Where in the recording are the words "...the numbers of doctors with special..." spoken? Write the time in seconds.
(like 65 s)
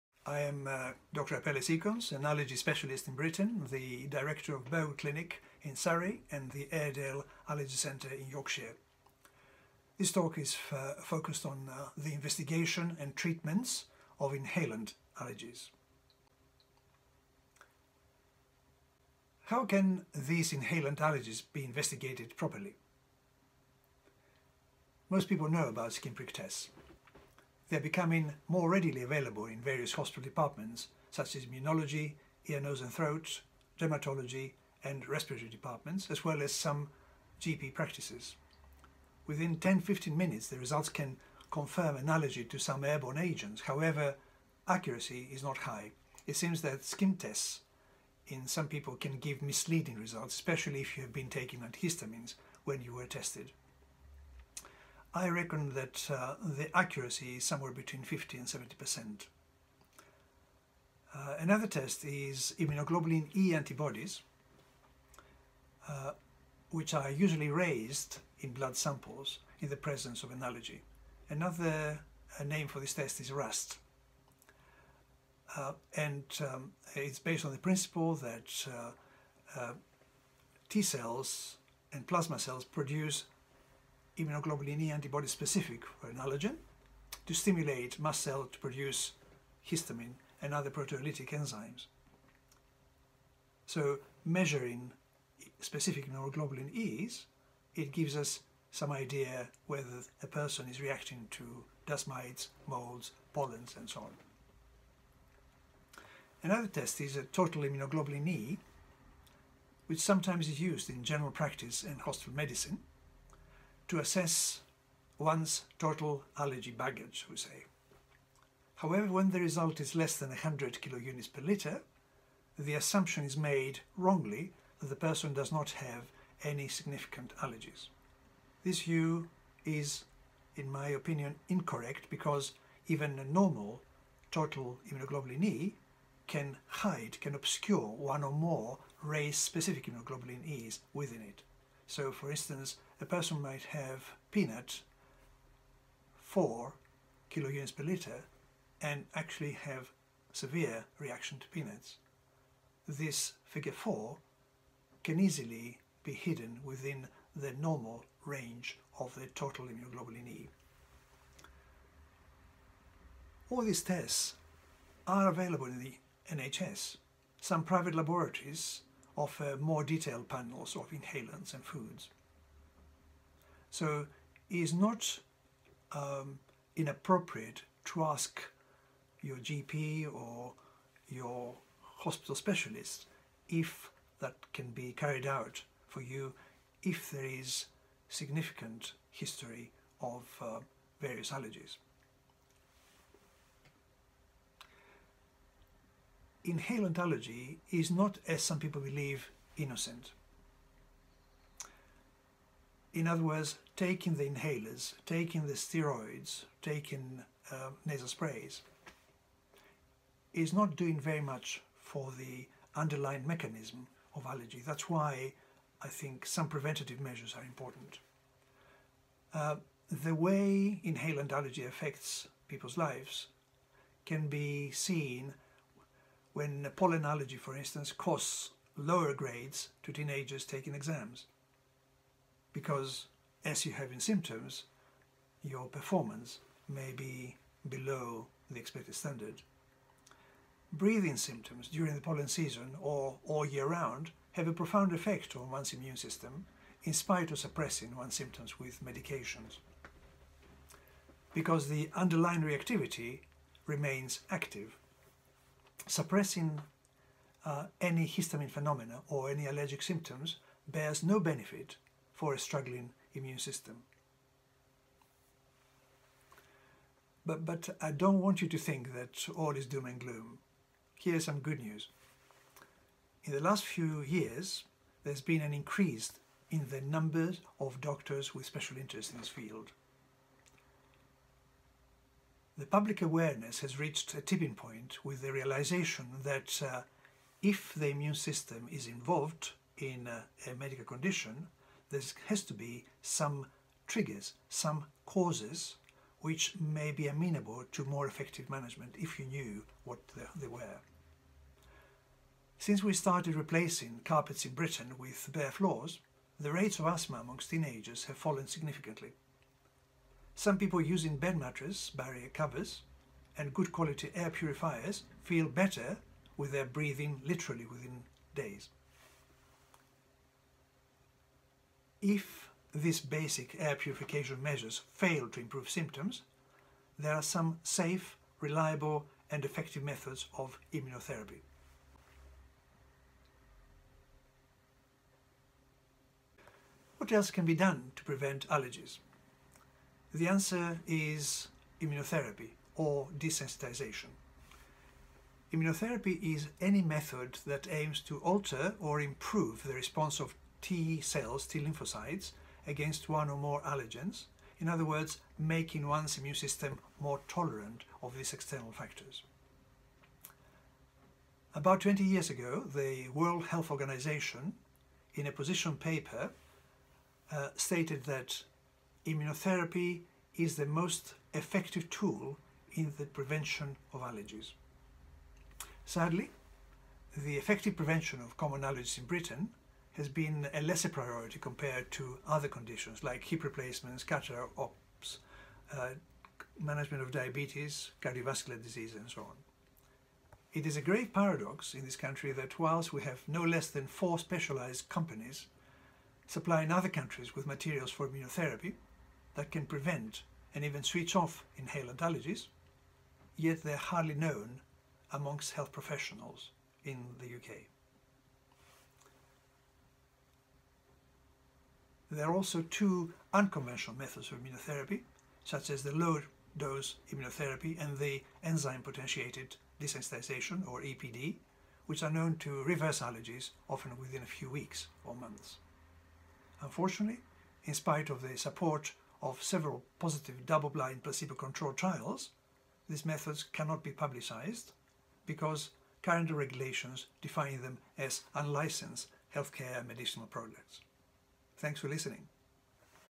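276 s.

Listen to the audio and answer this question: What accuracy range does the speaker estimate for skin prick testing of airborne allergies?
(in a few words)
50 to 70%.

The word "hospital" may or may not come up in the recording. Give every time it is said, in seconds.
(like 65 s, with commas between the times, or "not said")
29 s, 112 s, 181 s.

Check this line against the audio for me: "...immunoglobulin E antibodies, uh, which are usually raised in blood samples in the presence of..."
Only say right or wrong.
right.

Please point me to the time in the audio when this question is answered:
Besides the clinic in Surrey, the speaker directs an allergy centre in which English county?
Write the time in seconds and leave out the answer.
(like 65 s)
8 s.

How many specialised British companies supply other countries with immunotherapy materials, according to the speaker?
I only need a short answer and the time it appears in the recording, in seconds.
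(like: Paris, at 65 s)
4, at 393 s.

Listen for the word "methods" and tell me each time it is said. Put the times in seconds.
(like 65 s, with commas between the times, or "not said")
329 s, 346 s, 413 s, 433 s.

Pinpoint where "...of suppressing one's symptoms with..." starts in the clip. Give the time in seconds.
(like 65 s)
247 s.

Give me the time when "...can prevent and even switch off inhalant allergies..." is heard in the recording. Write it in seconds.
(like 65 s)
399 s.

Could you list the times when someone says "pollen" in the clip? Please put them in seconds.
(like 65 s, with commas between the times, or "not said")
103 s, 226 s, 242 s.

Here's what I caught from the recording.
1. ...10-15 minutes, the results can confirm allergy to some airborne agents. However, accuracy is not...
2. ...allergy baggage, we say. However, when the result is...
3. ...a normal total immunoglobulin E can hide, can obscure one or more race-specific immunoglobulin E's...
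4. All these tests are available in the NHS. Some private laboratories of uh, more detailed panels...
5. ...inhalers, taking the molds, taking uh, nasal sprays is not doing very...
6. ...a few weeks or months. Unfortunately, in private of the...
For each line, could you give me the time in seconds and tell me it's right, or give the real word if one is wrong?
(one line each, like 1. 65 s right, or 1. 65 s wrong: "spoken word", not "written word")
1. 39 s right
2. 116 s right
3. 133 s right
4. 163 s right
5. 204 s wrong: "steroids", not "molds"
6. 424 s wrong: "spite", not "private".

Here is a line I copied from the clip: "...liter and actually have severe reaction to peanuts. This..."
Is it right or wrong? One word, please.
right.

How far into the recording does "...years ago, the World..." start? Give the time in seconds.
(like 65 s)
362 s.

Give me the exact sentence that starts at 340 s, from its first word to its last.
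The answer is immunotherapy or desensitization.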